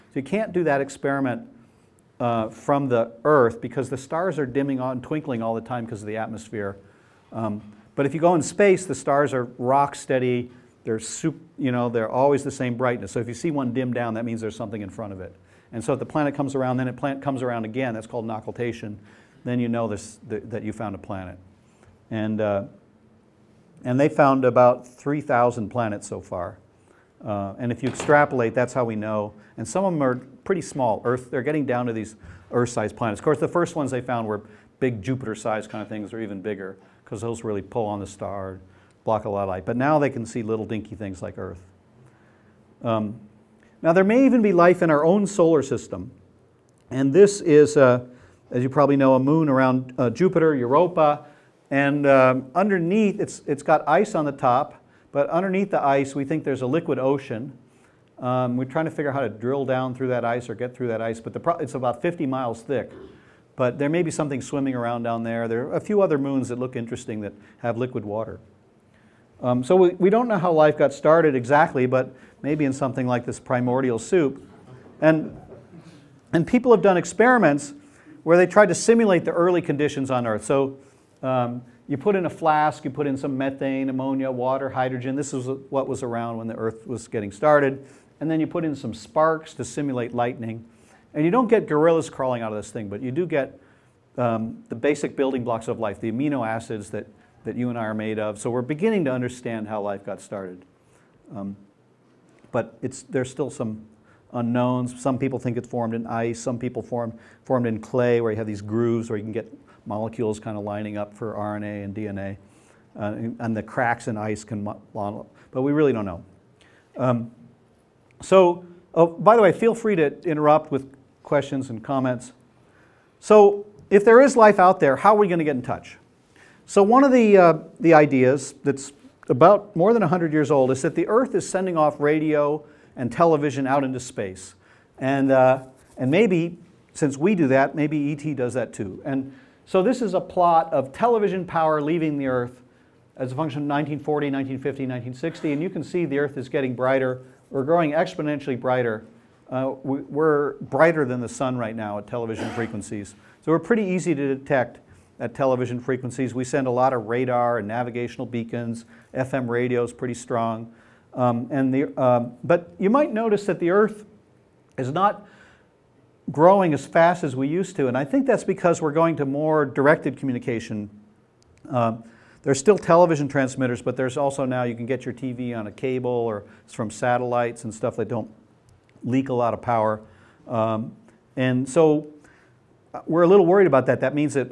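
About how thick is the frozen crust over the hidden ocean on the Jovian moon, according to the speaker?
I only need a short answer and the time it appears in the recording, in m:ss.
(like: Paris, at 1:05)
50 miles, at 1:02.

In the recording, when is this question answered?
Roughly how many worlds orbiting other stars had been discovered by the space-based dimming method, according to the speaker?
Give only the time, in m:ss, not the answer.
0:24.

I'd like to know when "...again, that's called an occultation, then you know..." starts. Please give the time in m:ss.
0:17.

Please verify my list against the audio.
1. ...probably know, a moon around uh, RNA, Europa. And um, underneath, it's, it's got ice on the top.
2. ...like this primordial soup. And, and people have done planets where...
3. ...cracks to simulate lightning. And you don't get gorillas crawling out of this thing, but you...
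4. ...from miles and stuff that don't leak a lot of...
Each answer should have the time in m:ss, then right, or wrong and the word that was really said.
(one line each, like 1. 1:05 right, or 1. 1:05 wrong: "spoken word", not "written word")
1. 0:48 wrong: "Jupiter", not "RNA"
2. 1:13 wrong: "experiments", not "planets"
3. 1:28 wrong: "sparks", not "cracks"
4. 2:56 wrong: "satellites", not "miles".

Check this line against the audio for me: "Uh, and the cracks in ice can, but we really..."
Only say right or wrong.
right.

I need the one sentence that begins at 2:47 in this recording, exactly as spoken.
And I think that's because we're going to more directed communication.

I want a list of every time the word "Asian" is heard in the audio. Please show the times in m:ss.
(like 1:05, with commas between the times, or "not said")
not said.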